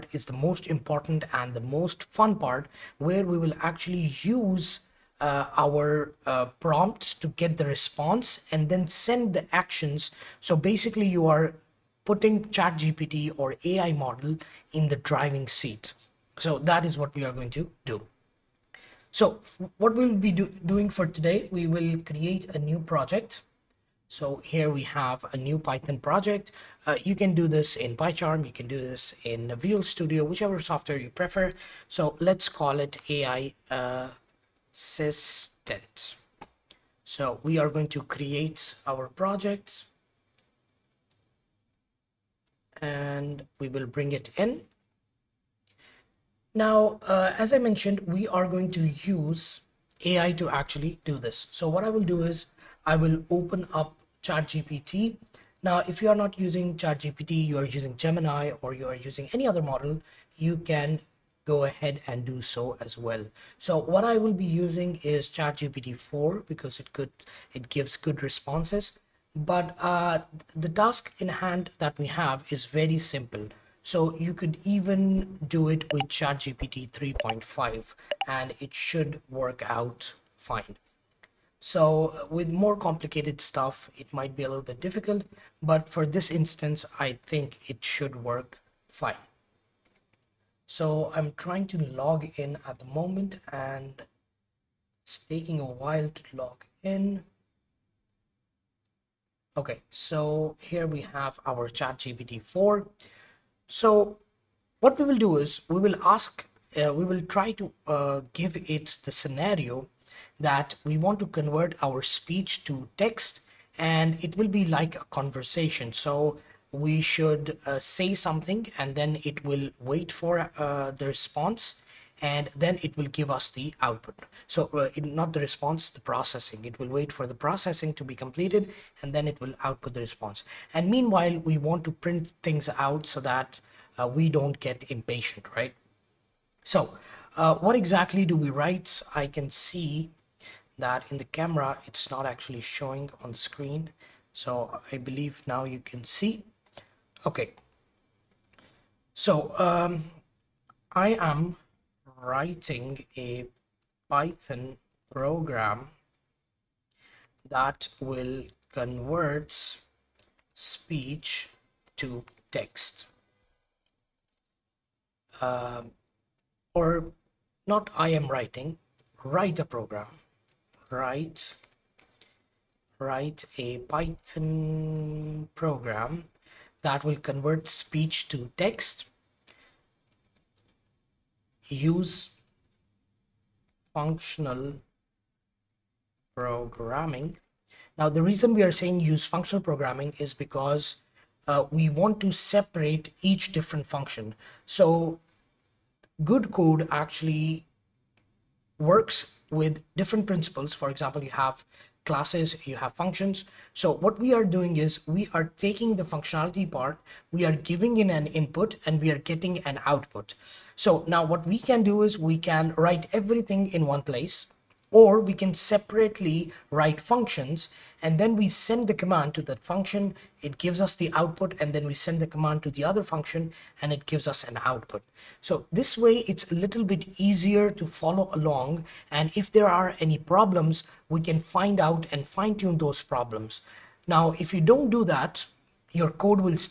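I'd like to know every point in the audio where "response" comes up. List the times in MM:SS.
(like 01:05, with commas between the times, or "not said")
00:07, 01:08, 02:01, 02:05, 02:10.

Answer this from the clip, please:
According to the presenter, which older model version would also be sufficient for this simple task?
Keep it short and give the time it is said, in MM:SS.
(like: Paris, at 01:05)
ChatGPT 3.5, at 01:16.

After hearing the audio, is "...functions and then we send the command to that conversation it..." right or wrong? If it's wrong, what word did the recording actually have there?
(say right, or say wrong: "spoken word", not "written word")
wrong: "function", not "conversation".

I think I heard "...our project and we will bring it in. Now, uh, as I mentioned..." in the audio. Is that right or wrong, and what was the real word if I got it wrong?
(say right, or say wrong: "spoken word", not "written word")
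right.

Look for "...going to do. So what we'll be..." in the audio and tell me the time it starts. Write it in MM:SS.
00:17.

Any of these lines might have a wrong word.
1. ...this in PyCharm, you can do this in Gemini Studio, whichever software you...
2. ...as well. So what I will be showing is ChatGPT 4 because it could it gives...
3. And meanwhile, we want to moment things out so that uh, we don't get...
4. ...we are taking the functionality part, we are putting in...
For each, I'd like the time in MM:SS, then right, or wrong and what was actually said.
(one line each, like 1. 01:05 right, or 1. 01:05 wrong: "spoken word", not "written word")
1. 00:27 wrong: "Visual", not "Gemini"
2. 01:02 wrong: "using", not "showing"
3. 02:10 wrong: "print", not "moment"
4. 03:25 wrong: "giving", not "putting".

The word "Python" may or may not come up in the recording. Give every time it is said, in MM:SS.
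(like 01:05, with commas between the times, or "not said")
00:25, 02:34, 02:53.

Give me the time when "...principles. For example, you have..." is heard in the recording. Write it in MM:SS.
03:20.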